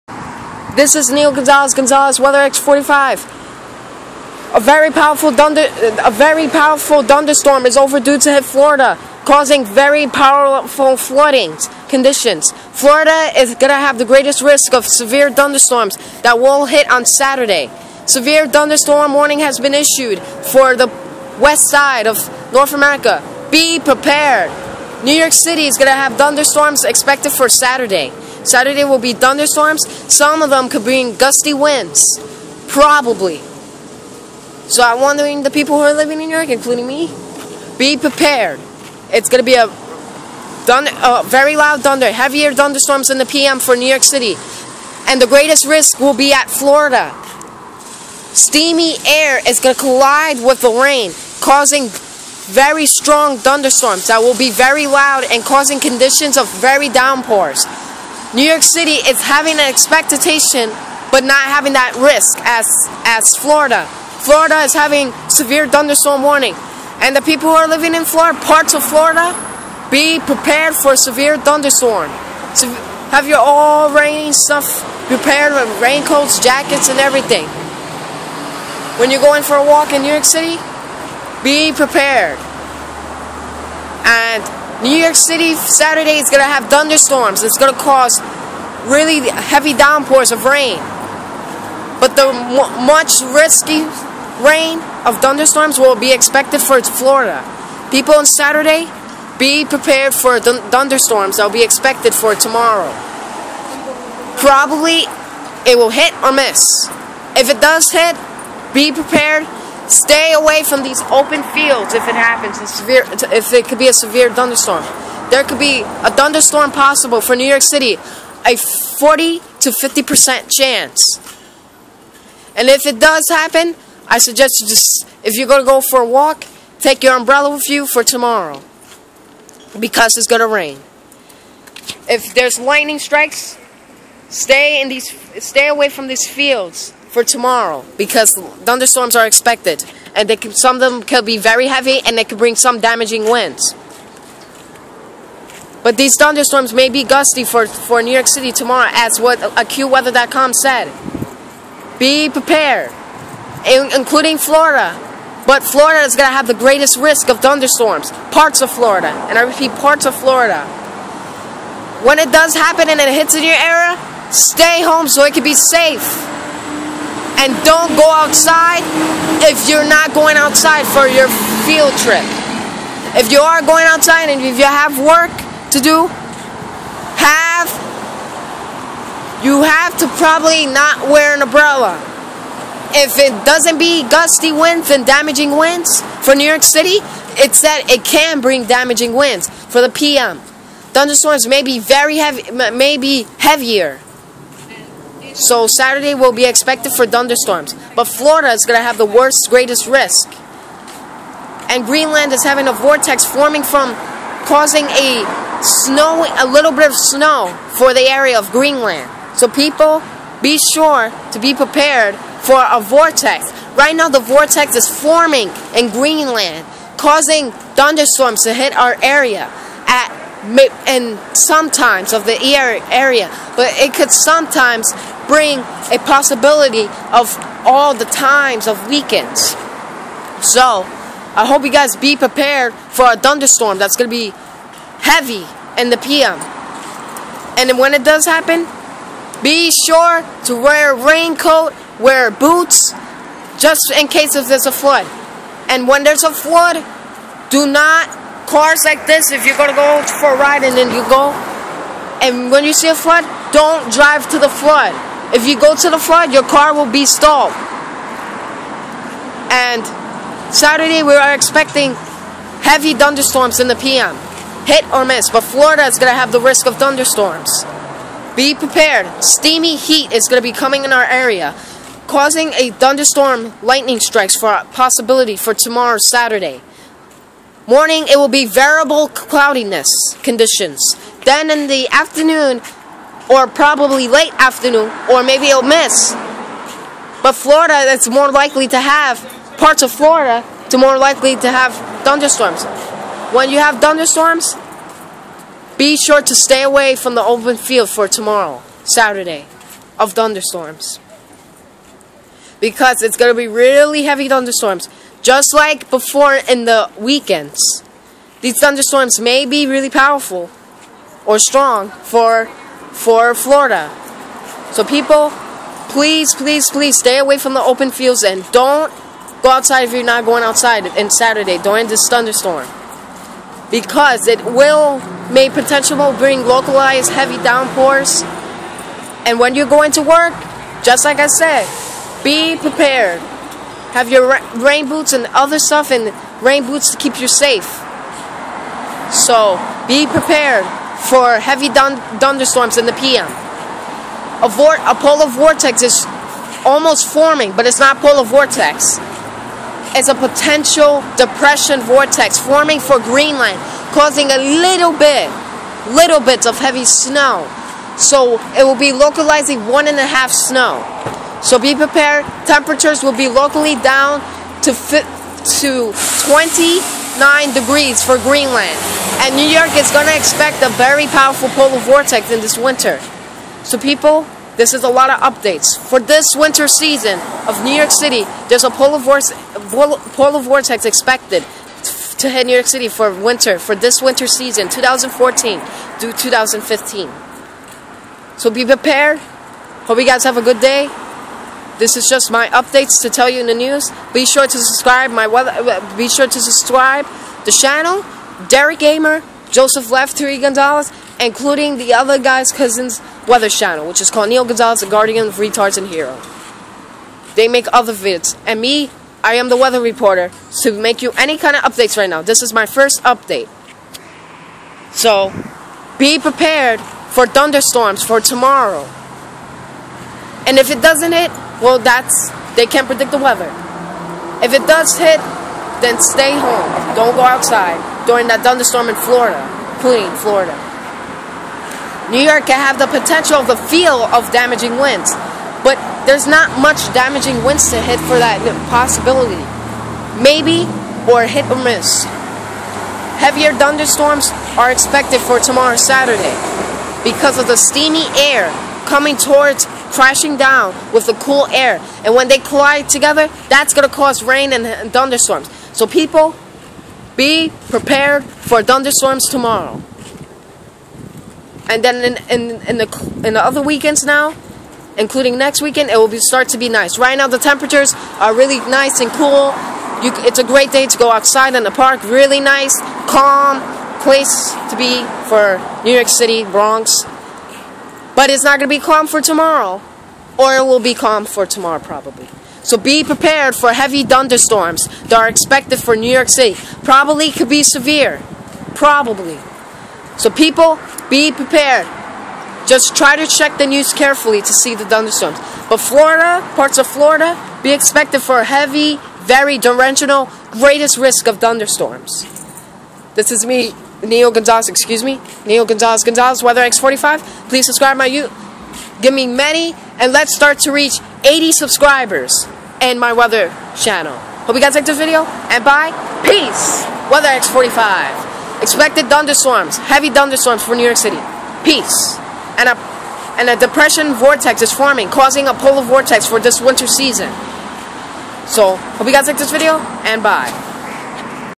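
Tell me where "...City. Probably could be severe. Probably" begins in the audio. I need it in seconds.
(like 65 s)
486 s.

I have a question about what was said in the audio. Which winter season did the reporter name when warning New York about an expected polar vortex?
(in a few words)
2014 to 2015.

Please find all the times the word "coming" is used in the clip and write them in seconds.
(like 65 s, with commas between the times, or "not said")
270 s, 448 s.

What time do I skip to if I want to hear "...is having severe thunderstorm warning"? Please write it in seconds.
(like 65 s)
64 s.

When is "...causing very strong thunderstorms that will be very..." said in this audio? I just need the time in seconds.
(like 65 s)
51 s.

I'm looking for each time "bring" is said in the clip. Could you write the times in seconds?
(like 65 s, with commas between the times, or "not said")
30 s, 142 s, 188 s, 225 s, 326 s.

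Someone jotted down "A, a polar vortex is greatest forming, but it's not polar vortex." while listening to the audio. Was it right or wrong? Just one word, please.
wrong.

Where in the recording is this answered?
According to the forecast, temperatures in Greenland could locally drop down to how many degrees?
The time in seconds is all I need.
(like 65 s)
366 s.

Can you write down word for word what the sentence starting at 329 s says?
And when you're going to work, just like I said, be prepared.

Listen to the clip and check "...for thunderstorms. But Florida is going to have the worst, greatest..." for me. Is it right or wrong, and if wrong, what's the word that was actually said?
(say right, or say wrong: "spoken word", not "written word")
right.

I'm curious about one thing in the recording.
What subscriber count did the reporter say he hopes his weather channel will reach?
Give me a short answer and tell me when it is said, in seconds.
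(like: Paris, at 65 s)
80 subscribers, at 511 s.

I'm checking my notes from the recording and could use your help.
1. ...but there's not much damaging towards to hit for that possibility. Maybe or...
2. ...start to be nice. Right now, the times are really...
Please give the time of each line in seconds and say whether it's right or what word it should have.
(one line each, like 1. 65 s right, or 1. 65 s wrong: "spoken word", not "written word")
1. 435 s wrong: "winds", not "towards"
2. 466 s wrong: "temperatures", not "times".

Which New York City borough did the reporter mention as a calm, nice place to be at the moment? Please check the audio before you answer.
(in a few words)
Bronx.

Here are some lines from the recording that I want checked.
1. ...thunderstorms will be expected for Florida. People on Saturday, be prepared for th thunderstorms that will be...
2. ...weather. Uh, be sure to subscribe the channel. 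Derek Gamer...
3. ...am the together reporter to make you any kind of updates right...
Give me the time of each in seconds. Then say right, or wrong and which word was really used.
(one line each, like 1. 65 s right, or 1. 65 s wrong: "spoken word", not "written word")
1. 95 s right
2. 395 s right
3. 409 s wrong: "weather", not "together".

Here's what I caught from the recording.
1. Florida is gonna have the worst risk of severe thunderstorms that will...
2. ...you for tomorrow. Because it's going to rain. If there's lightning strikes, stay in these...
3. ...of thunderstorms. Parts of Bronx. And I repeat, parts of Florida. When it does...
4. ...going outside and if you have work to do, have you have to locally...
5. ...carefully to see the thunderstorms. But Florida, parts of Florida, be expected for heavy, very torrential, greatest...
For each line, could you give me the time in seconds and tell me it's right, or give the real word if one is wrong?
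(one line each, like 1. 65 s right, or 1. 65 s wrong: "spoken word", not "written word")
1. 12 s wrong: "greatest", not "worst"
2. 127 s right
3. 157 s wrong: "Florida", not "Bronx"
4. 173 s wrong: "probably", not "locally"
5. 493 s right.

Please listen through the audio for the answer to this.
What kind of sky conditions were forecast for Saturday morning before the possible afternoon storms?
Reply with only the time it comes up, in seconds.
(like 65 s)
278 s.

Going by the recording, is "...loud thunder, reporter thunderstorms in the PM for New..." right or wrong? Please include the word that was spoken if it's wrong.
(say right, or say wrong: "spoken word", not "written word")
wrong: "heavier", not "reporter".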